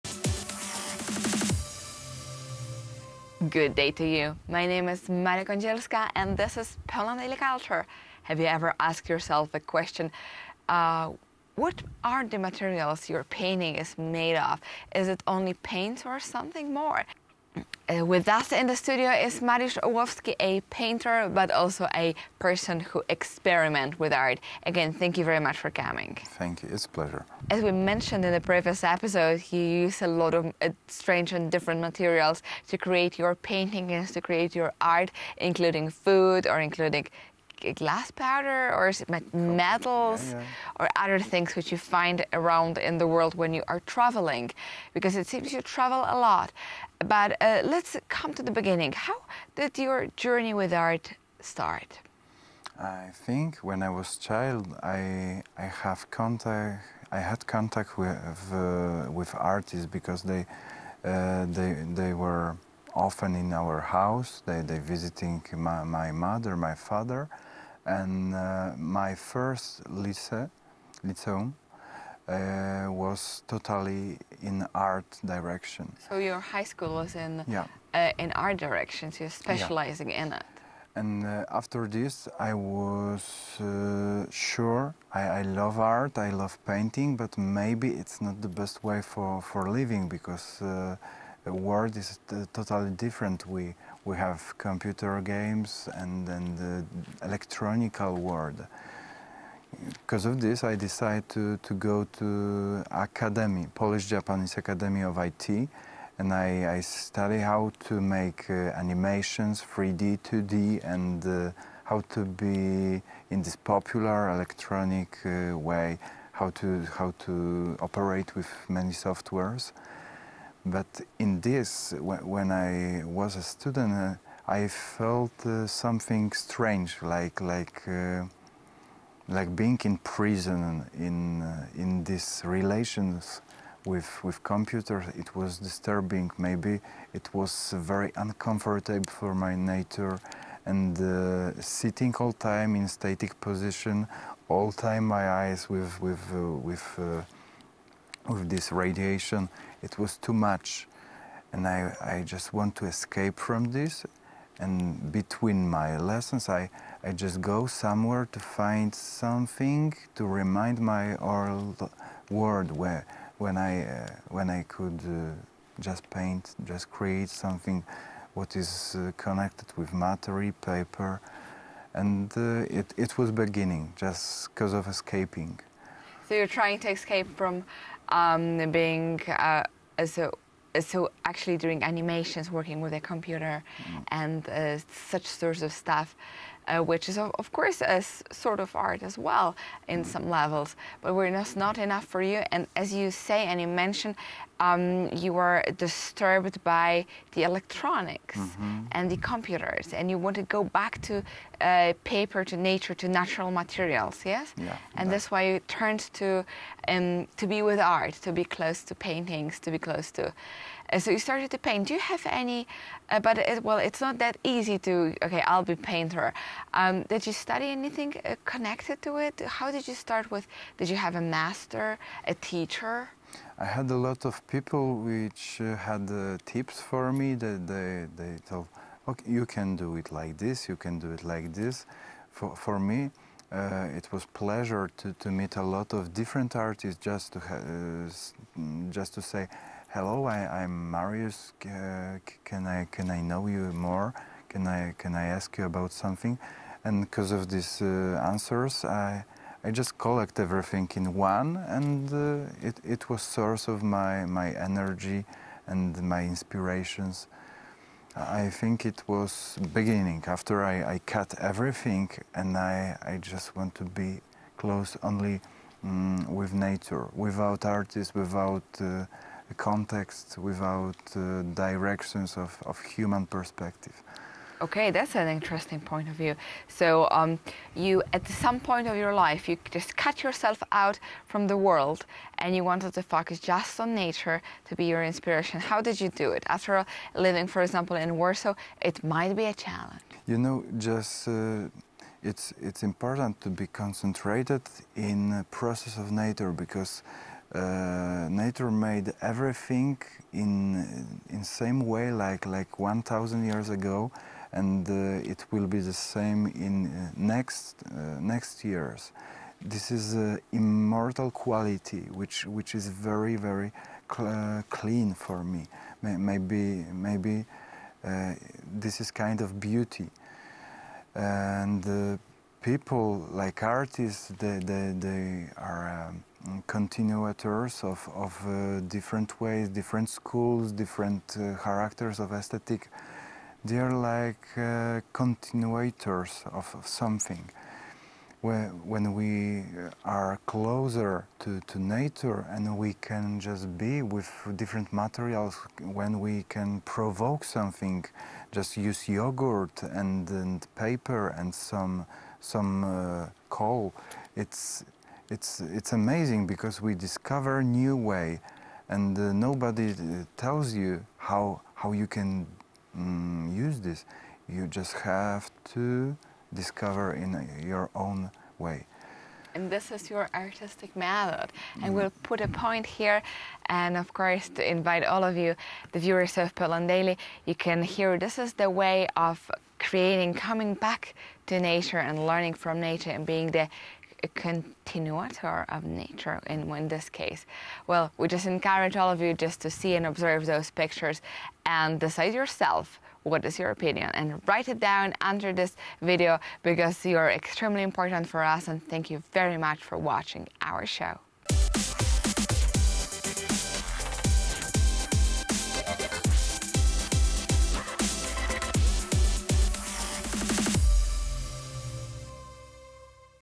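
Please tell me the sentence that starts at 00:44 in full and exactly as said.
Because it seems you travel a lot.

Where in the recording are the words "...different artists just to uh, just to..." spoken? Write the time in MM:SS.
03:56.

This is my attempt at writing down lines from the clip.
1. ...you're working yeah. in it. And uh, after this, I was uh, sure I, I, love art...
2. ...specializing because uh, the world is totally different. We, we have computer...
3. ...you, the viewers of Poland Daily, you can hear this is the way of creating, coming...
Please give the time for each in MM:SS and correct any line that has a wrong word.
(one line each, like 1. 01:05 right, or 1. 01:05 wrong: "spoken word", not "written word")
1. 01:19 wrong: "specializing", not "working"
2. 01:29 wrong: "living", not "specializing"
3. 06:15 right.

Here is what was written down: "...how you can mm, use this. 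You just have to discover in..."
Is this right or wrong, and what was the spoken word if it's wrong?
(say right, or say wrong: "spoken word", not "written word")
right.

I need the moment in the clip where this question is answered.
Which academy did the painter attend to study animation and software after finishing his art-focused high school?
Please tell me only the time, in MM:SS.
01:43.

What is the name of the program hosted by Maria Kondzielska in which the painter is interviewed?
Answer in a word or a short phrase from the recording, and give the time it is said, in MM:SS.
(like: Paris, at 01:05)
Poland Daily Culture, at 00:06.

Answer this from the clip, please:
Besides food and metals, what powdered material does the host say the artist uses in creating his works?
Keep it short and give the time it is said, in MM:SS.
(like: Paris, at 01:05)
glass powder, at 00:37.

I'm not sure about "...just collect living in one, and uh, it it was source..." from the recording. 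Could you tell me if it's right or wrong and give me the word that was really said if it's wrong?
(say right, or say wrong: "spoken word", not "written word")
wrong: "everything", not "living".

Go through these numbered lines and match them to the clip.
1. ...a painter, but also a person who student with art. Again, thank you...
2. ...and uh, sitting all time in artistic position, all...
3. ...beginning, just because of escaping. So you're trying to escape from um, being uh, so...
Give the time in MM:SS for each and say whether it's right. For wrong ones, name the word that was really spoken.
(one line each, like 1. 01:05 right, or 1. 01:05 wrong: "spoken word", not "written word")
1. 00:20 wrong: "experiment", not "student"
2. 02:20 wrong: "static", not "artistic"
3. 02:53 right.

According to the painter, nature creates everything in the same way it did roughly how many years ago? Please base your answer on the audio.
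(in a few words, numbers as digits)
1000.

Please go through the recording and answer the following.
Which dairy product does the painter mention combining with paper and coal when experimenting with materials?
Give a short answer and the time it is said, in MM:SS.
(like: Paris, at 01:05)
yogurt, at 05:49.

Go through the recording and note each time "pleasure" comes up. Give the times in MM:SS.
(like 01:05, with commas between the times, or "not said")
00:26, 03:54.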